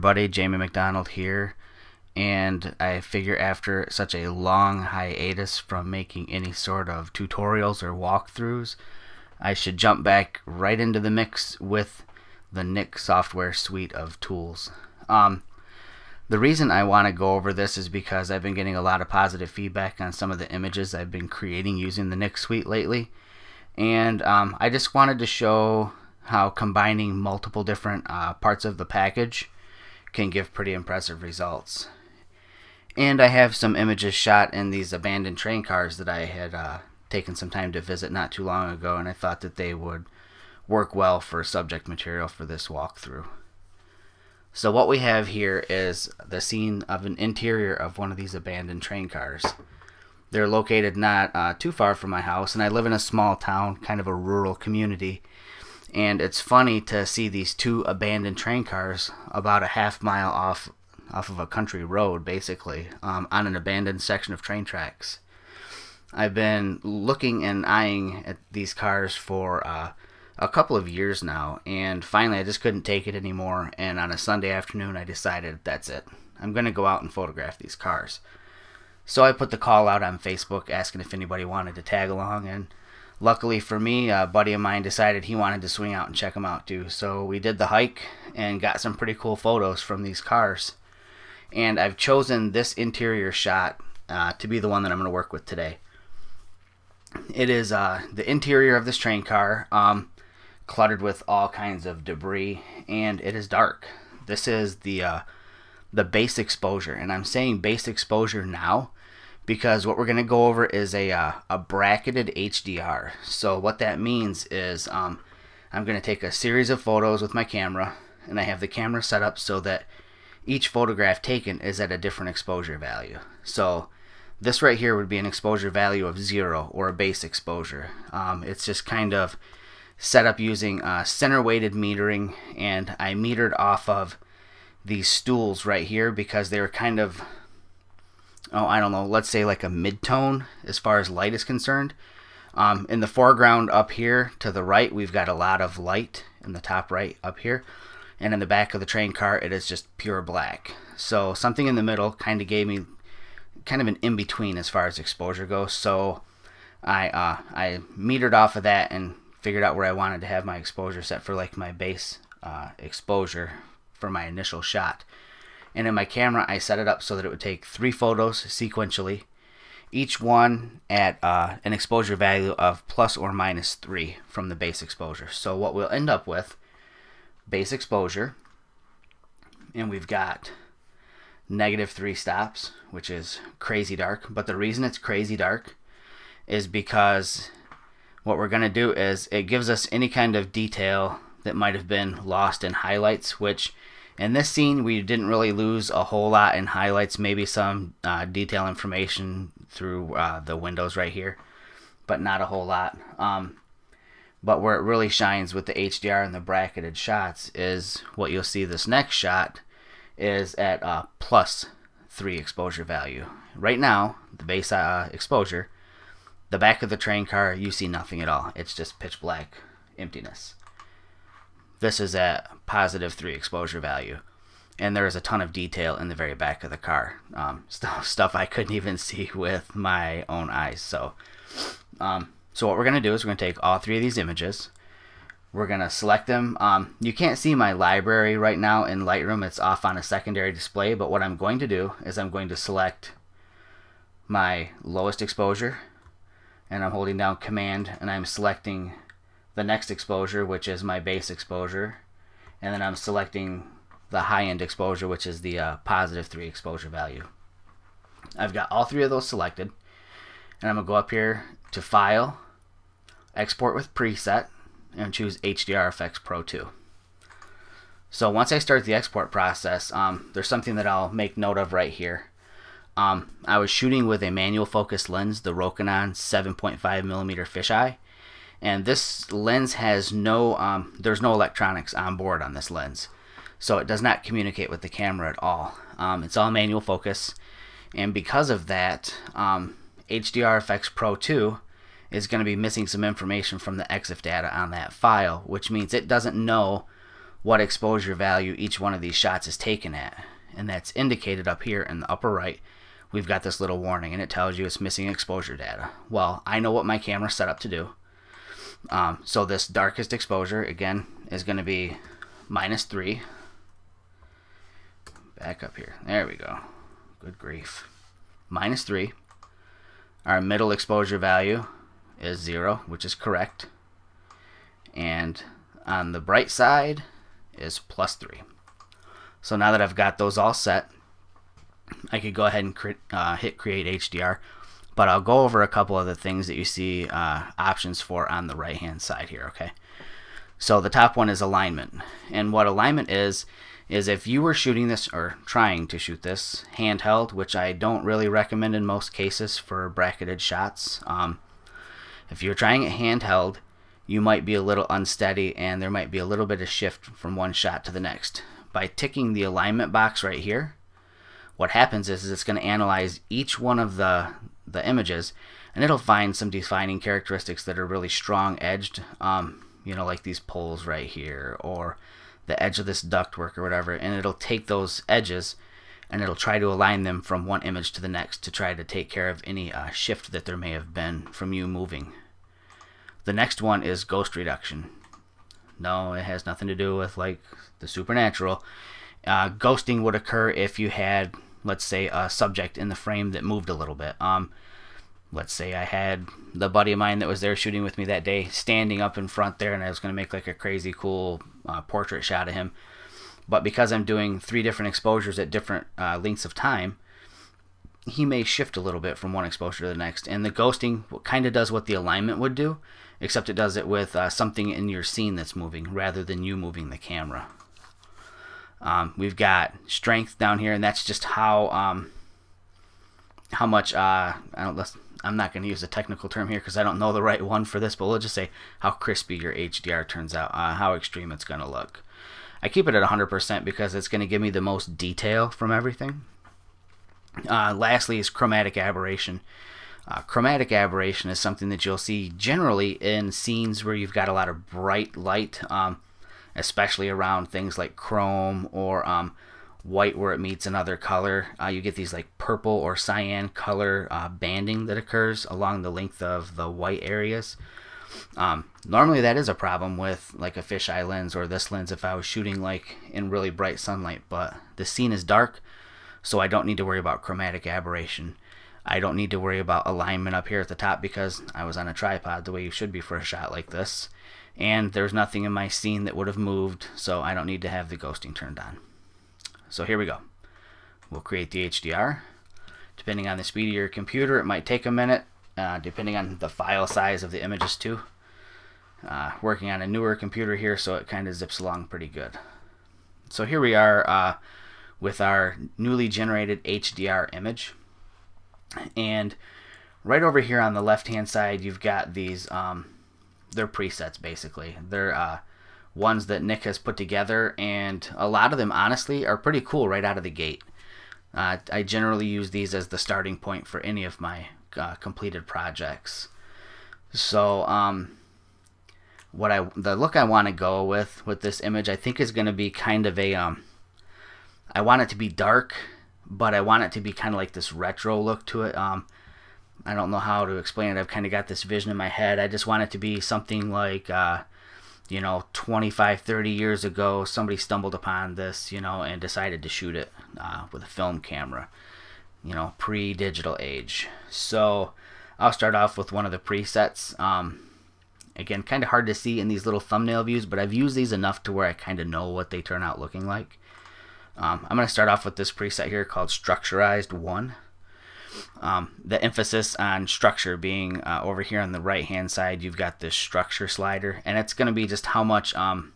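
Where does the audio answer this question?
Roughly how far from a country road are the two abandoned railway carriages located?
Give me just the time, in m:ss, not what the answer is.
0:59.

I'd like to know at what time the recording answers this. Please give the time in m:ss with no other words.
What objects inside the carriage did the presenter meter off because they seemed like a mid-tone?
2:15.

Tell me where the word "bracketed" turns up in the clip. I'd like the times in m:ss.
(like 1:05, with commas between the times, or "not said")
1:51, 3:26, 5:49.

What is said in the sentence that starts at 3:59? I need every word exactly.
It's off on a secondary display.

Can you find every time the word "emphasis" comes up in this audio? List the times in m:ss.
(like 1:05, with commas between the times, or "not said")
9:19.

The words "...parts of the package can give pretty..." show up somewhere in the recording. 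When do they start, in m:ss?
0:28.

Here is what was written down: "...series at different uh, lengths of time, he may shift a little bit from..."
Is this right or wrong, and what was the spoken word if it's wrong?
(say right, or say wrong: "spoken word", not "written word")
wrong: "exposures", not "series".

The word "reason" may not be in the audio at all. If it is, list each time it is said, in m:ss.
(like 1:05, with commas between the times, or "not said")
0:16, 3:04.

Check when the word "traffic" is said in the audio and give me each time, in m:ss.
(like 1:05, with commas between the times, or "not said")
not said.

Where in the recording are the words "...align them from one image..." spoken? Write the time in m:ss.
6:16.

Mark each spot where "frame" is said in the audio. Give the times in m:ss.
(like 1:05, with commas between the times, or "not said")
6:32.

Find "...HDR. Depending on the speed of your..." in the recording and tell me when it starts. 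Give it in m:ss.
8:01.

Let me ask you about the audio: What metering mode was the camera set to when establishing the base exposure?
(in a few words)
center weighted metering.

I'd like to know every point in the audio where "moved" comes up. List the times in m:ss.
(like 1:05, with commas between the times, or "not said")
6:33, 7:56.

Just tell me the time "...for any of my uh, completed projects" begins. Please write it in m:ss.
8:33.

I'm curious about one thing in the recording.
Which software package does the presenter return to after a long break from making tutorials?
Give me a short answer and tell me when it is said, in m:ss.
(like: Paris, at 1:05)
Nik software suite, at 0:12.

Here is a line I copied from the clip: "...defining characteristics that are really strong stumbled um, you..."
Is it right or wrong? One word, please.
wrong.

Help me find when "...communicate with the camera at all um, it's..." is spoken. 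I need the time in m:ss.
4:44.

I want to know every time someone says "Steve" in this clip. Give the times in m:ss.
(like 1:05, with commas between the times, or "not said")
not said.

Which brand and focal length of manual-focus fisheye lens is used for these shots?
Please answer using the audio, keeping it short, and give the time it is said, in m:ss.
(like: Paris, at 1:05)
Rokinon 7.5mm, at 4:35.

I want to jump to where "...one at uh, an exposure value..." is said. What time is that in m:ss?
2:50.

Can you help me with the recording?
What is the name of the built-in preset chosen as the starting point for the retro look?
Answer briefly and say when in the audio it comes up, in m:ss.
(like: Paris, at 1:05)
Structurized 1, at 9:16.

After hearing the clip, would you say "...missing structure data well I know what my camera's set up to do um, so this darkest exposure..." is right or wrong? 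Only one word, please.
wrong.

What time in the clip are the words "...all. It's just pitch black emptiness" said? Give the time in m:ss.
3:38.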